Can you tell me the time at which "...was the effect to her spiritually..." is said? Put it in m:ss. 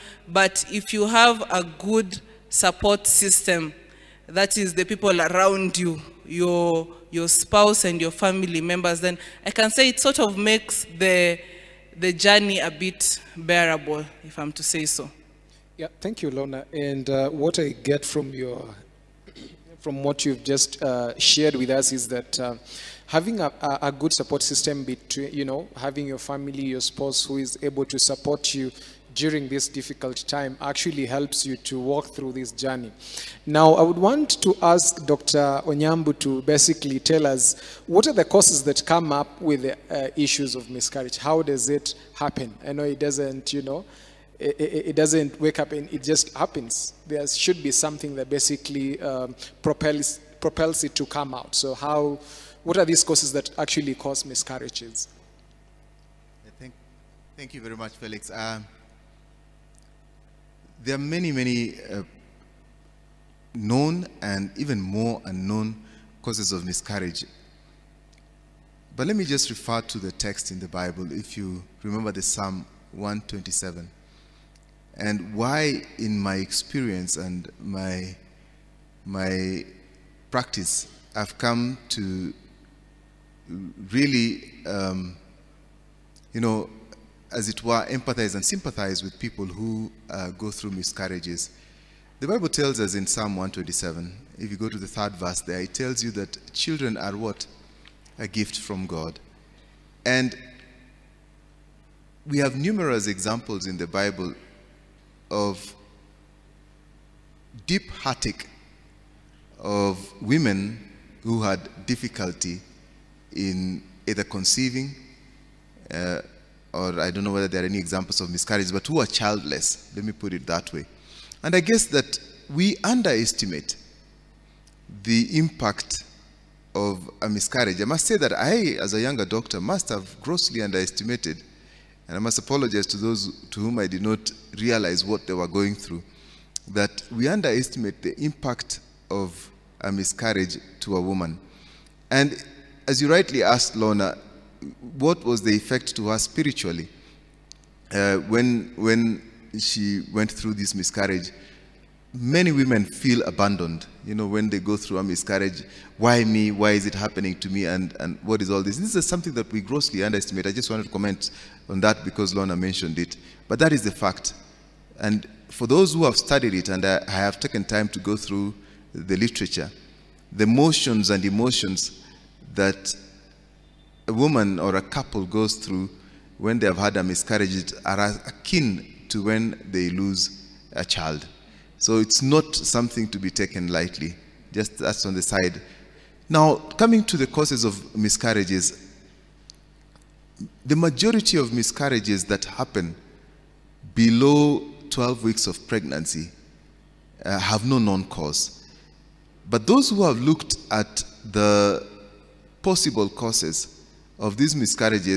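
2:25.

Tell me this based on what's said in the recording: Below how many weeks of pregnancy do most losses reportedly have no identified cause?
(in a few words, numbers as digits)
12.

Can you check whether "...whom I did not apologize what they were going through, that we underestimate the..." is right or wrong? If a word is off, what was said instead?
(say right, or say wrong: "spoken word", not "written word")
wrong: "realize", not "apologize".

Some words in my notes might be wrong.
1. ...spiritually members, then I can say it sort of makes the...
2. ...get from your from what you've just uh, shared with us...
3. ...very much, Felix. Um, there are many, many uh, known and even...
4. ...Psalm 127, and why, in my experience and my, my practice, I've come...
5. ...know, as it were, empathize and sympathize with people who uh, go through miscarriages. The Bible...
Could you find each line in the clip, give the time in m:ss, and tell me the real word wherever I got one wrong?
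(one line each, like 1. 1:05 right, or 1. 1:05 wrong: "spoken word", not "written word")
1. 0:08 wrong: "family", not "spiritually"
2. 0:17 right
3. 0:57 right
4. 1:12 right
5. 1:26 right.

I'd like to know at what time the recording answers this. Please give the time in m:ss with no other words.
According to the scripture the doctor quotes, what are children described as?
1:38.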